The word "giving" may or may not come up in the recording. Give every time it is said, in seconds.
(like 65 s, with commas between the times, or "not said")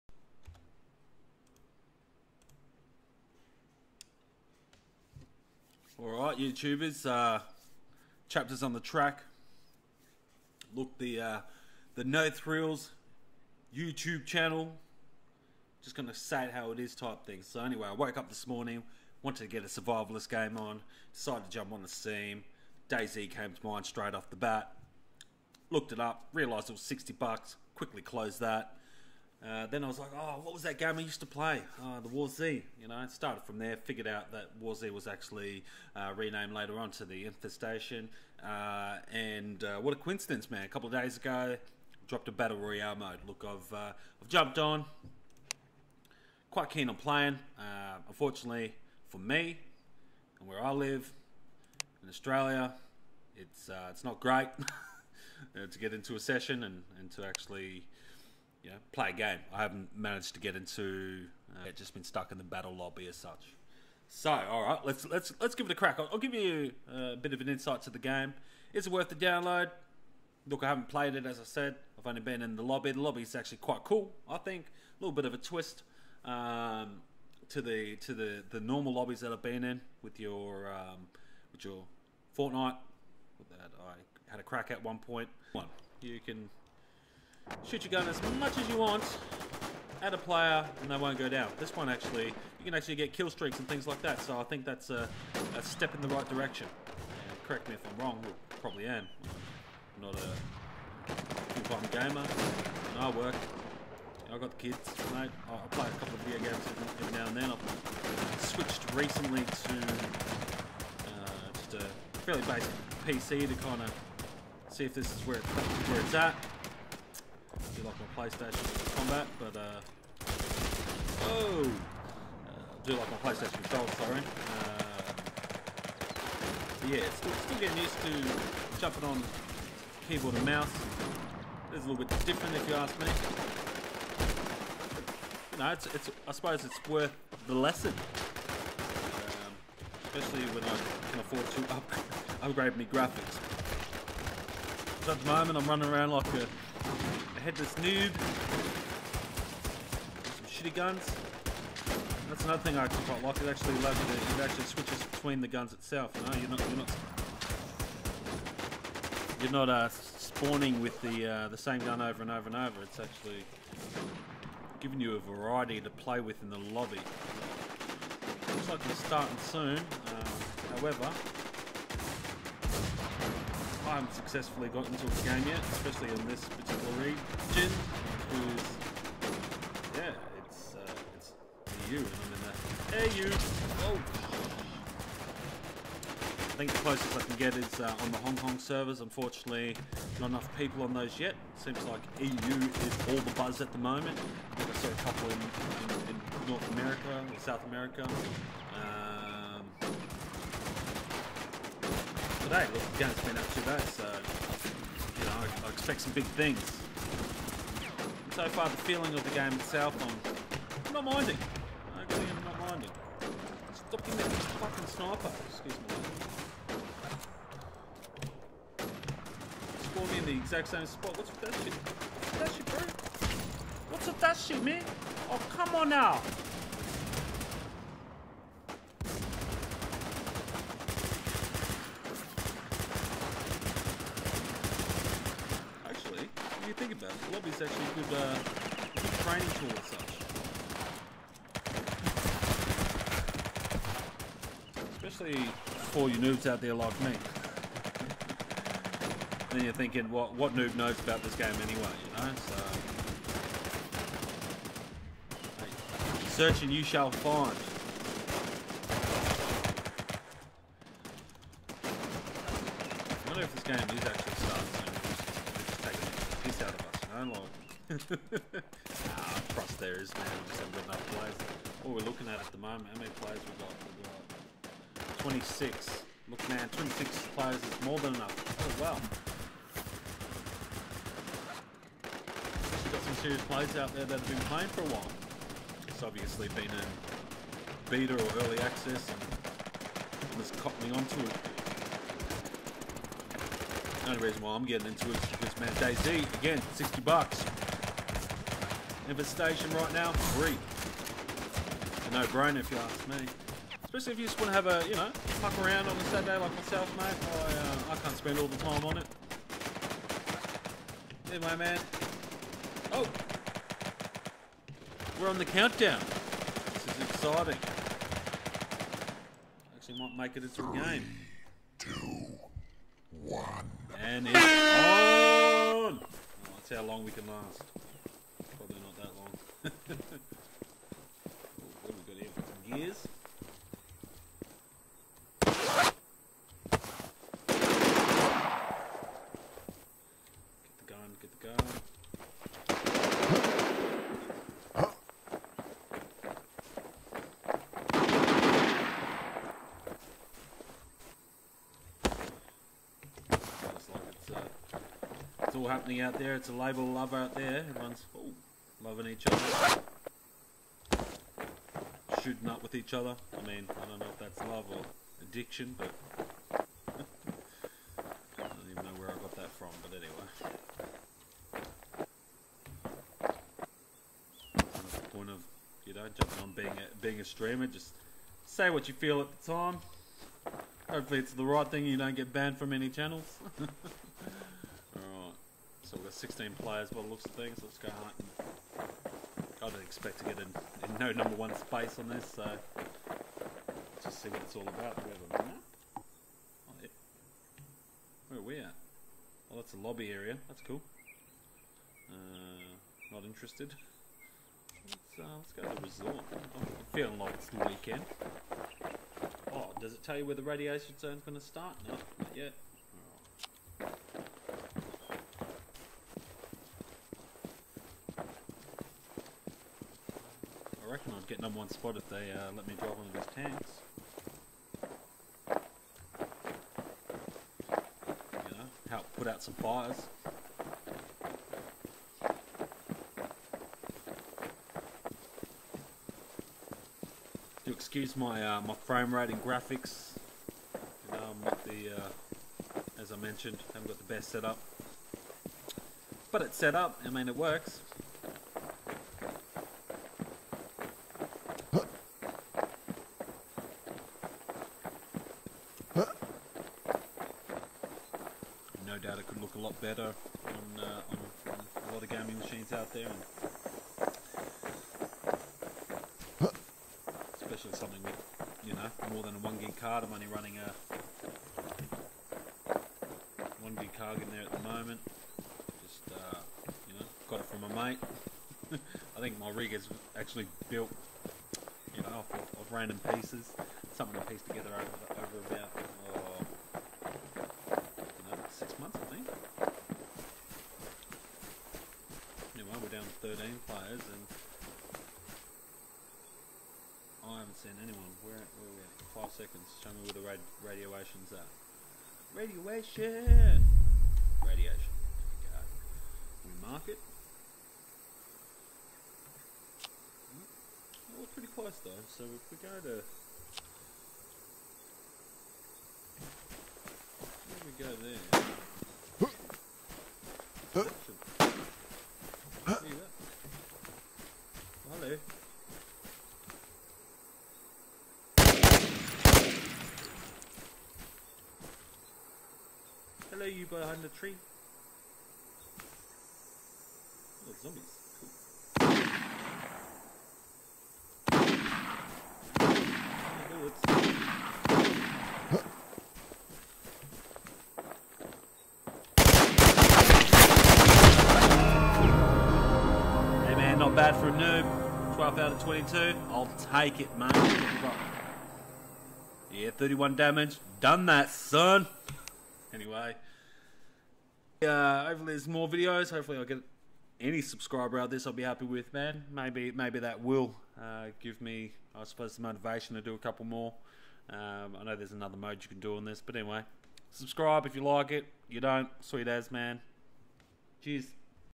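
164 s, 214 s.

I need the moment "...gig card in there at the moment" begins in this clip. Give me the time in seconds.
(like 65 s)
473 s.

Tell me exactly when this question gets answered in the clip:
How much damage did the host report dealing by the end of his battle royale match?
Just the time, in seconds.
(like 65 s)
559 s.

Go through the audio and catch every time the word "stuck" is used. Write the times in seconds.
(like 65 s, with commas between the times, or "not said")
62 s.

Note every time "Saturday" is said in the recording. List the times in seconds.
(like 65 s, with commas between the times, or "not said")
306 s.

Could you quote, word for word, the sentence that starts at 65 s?
I'll, I'll give you uh, a bit of an insight to the game.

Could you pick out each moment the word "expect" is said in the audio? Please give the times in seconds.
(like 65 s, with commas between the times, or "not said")
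205 s, 389 s.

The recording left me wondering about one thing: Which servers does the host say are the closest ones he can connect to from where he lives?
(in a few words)
Hong Kong.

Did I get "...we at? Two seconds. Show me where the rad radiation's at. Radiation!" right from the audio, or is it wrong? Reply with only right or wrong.
wrong.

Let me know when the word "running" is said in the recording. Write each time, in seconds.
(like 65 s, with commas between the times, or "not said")
145 s, 470 s.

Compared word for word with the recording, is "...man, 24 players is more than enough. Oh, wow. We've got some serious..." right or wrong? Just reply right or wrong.
wrong.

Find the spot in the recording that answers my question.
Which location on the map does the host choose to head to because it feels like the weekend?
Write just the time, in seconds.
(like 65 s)
405 s.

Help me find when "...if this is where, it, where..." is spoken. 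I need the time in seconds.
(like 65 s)
114 s.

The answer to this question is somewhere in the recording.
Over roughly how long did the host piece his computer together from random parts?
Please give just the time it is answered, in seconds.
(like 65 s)
488 s.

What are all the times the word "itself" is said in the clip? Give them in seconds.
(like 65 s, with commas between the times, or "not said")
155 s, 209 s.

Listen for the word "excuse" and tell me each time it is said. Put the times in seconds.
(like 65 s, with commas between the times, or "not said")
215 s, 437 s.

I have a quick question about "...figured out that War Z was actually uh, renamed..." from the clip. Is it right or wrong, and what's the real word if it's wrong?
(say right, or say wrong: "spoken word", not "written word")
right.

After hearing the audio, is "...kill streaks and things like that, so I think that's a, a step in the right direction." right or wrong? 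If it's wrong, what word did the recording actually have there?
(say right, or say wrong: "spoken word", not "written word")
right.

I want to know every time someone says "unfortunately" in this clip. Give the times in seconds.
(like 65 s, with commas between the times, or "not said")
48 s, 189 s.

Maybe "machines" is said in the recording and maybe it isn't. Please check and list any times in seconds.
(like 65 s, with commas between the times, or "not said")
462 s.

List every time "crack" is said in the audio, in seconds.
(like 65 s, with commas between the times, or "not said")
65 s, 84 s.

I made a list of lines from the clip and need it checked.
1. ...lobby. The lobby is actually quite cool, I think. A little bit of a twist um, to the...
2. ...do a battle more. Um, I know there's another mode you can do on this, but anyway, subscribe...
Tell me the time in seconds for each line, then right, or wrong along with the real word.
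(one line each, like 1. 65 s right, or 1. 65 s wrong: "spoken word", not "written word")
1. 72 s right
2. 573 s wrong: "couple", not "battle".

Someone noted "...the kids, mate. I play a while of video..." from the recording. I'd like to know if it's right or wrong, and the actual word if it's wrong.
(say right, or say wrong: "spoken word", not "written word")
wrong: "couple", not "while".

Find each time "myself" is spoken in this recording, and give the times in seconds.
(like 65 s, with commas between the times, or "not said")
306 s.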